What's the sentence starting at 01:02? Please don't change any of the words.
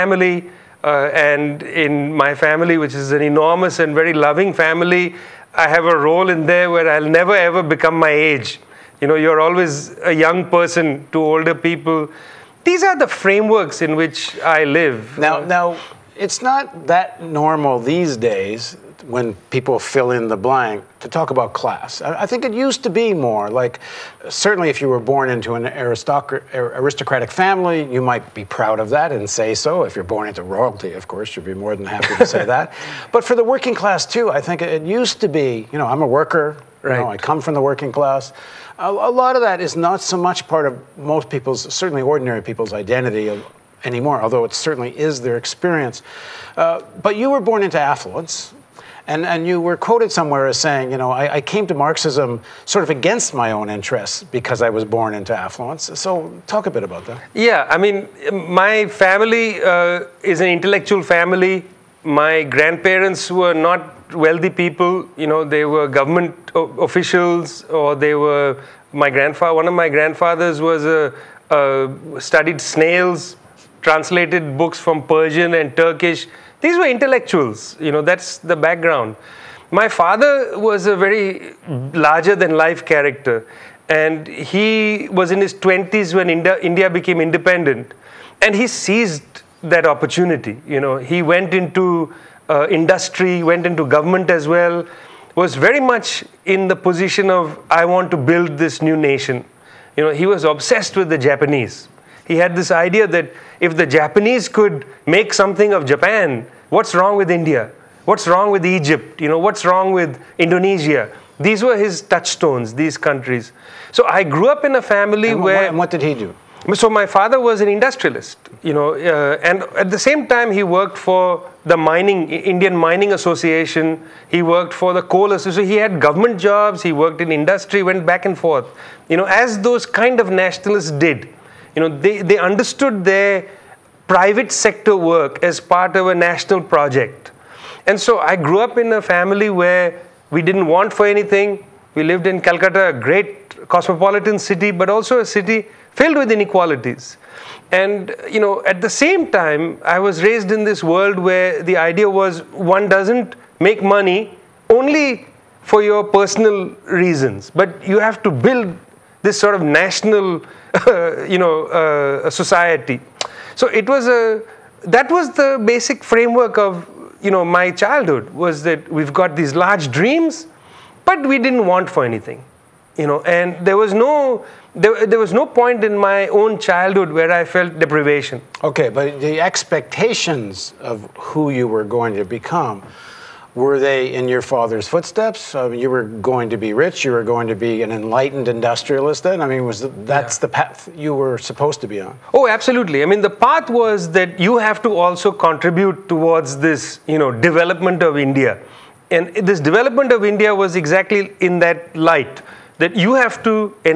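My grandparents were not wealthy people.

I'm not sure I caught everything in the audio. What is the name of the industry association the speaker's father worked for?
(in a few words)
Indian Mining Association.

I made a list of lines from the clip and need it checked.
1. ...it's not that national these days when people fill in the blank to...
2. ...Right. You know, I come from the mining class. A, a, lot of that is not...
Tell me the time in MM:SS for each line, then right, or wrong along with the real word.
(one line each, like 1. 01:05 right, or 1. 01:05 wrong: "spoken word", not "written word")
1. 00:16 wrong: "normal", not "national"
2. 00:36 wrong: "working", not "mining".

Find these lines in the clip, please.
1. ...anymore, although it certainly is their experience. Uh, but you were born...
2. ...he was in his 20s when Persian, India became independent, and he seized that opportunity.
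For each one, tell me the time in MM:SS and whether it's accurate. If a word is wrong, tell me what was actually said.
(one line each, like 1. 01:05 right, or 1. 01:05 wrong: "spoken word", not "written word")
1. 00:43 right
2. 01:24 wrong: "India", not "Persian".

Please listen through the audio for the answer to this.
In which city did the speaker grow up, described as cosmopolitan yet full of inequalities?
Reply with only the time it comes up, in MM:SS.
02:22.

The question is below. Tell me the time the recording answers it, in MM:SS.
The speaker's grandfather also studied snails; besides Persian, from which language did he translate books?
01:15.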